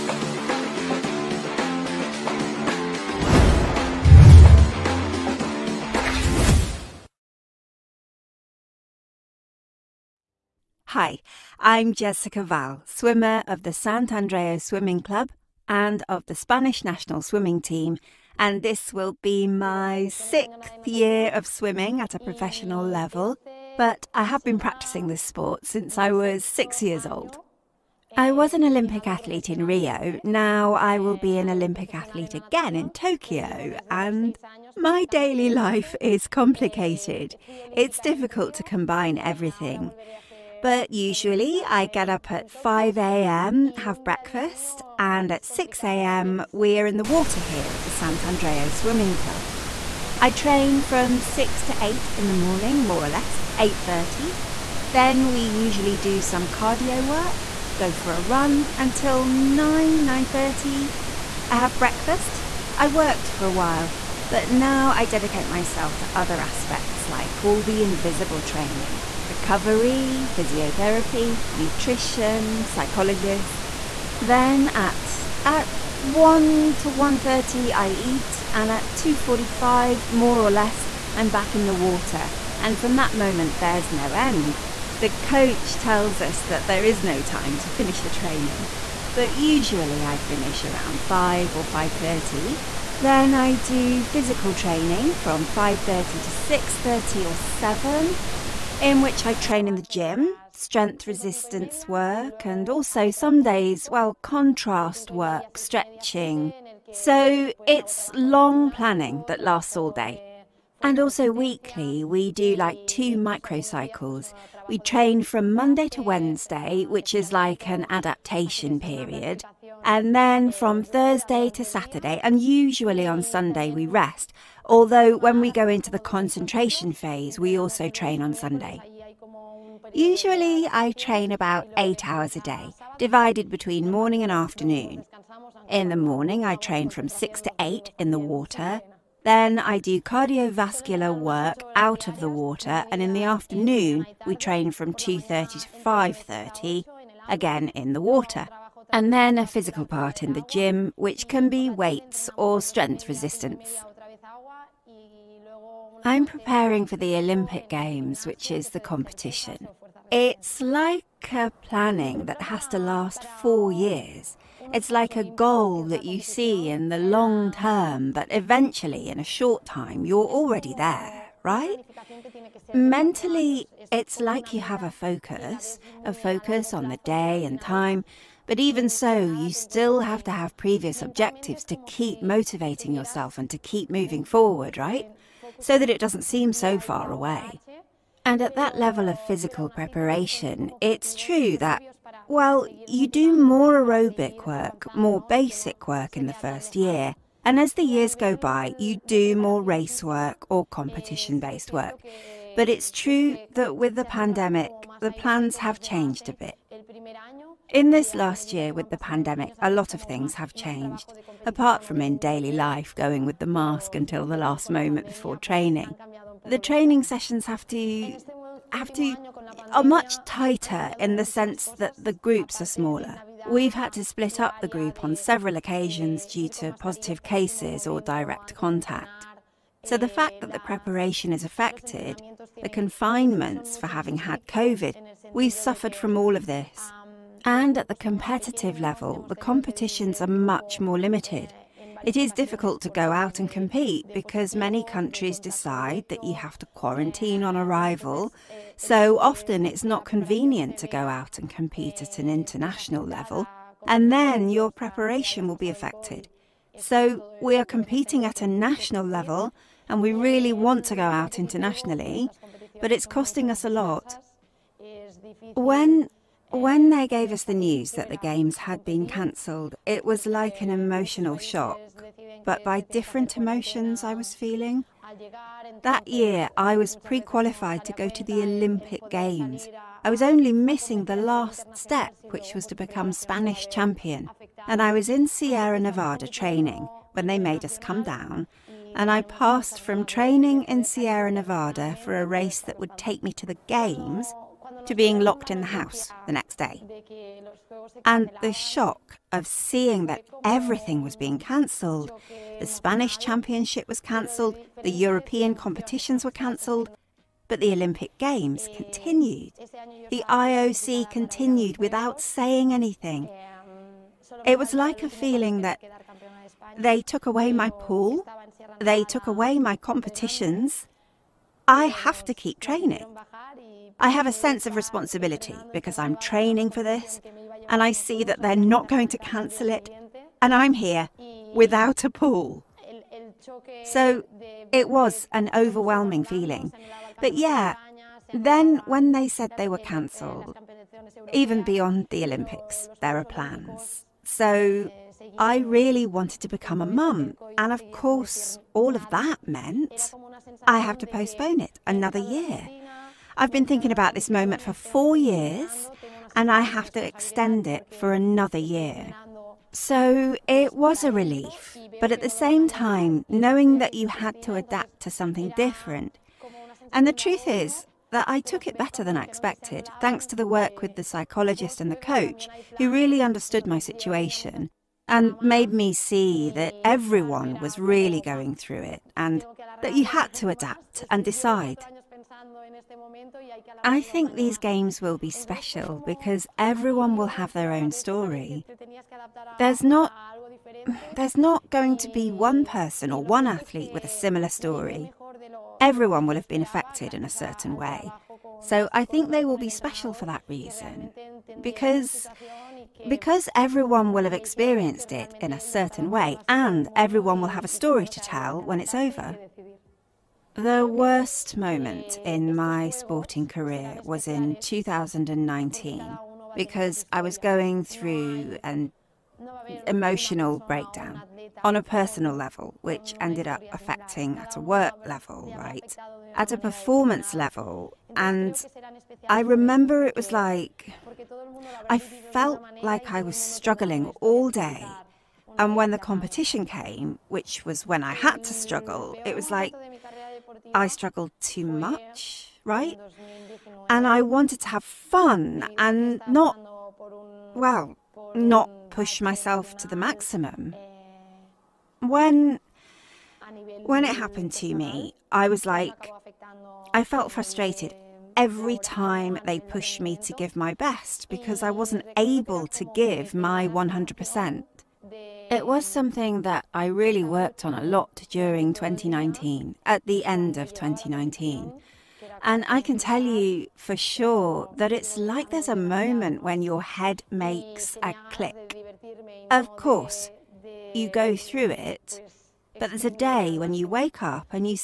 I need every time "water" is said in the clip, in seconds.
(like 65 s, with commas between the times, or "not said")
47 s, 81 s, 138 s, 142 s, 148 s.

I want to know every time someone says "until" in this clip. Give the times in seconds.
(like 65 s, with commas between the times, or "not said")
58 s, 213 s.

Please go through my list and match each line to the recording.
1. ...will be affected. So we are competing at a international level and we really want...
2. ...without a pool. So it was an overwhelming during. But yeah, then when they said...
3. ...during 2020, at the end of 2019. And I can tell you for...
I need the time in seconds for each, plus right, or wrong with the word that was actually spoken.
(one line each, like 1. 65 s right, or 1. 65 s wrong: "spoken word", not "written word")
1. 255 s wrong: "national", not "international"
2. 331 s wrong: "feeling", not "during"
3. 468 s wrong: "2019", not "2020".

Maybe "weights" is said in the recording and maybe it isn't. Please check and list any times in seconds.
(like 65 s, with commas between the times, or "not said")
151 s.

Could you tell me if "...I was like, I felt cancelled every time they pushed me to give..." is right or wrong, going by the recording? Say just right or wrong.
wrong.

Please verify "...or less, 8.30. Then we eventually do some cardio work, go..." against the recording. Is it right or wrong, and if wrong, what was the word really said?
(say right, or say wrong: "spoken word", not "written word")
wrong: "usually", not "eventually".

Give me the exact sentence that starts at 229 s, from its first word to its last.
So the fact that the preparation is affected, the confinements for having had COVID, we've suffered from all of this.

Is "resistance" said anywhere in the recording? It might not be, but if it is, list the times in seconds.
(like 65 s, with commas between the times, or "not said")
101 s, 153 s.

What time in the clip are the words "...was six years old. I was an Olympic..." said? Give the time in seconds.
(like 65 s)
26 s.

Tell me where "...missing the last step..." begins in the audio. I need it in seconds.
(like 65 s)
280 s.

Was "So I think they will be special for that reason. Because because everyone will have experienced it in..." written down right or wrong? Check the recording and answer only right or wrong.
right.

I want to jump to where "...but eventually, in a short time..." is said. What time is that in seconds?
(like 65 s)
168 s.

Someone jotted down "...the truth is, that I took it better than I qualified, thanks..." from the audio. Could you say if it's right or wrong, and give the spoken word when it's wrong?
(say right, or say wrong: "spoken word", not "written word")
wrong: "expected", not "qualified".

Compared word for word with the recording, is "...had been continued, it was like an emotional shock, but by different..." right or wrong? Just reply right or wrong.
wrong.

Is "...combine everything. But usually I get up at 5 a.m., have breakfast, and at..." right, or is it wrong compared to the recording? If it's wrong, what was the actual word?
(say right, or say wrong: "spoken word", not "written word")
right.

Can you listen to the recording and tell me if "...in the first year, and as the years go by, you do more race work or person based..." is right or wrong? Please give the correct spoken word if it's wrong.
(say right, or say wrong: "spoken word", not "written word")
wrong: "competition", not "person".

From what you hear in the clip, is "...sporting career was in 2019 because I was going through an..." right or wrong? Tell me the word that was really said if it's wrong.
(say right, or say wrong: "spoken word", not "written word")
right.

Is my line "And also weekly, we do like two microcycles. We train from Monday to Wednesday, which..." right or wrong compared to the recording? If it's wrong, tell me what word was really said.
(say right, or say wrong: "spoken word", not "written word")
right.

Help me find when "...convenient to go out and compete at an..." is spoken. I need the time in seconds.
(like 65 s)
250 s.